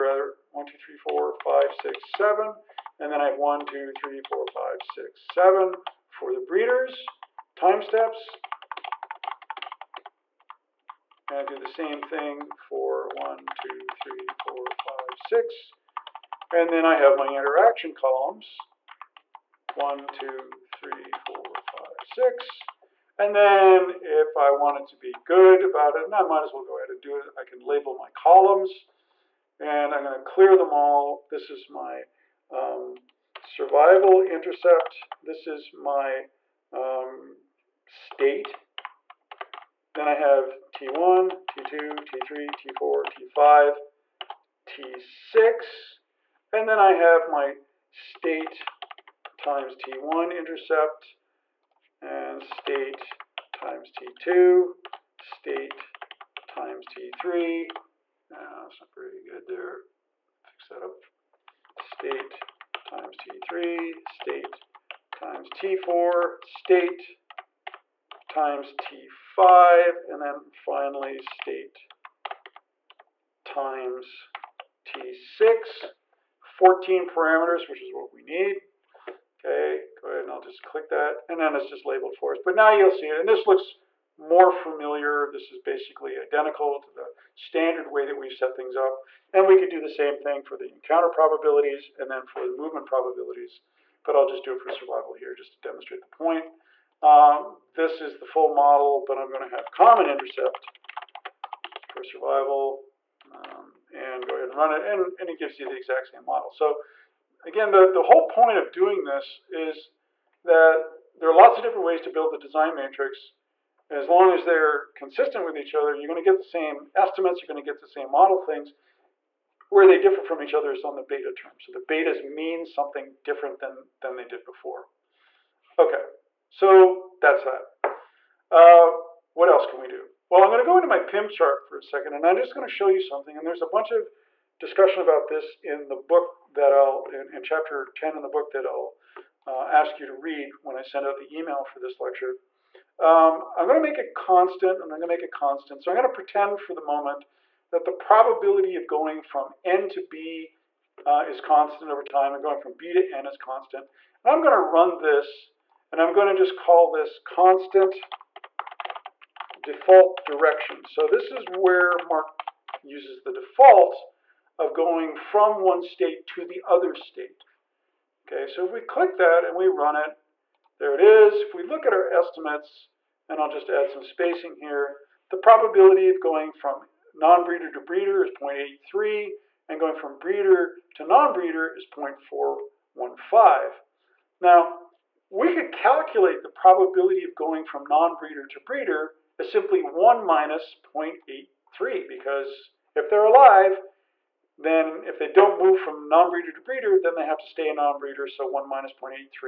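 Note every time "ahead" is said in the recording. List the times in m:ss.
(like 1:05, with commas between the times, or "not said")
0:26, 1:20, 1:44.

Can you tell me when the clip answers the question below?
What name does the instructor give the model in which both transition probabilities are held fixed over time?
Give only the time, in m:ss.
2:37.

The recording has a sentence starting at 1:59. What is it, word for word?
Where they differ from each other is on the beta term.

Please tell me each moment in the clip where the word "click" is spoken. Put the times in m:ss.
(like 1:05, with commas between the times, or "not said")
1:20, 2:48.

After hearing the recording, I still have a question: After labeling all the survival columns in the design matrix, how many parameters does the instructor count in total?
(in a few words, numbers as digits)
14.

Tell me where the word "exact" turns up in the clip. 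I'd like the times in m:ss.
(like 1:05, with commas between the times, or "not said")
1:45.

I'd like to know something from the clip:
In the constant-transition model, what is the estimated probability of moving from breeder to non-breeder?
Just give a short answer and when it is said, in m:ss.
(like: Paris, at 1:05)
0.415, at 3:01.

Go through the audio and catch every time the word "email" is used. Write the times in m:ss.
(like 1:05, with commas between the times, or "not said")
2:21.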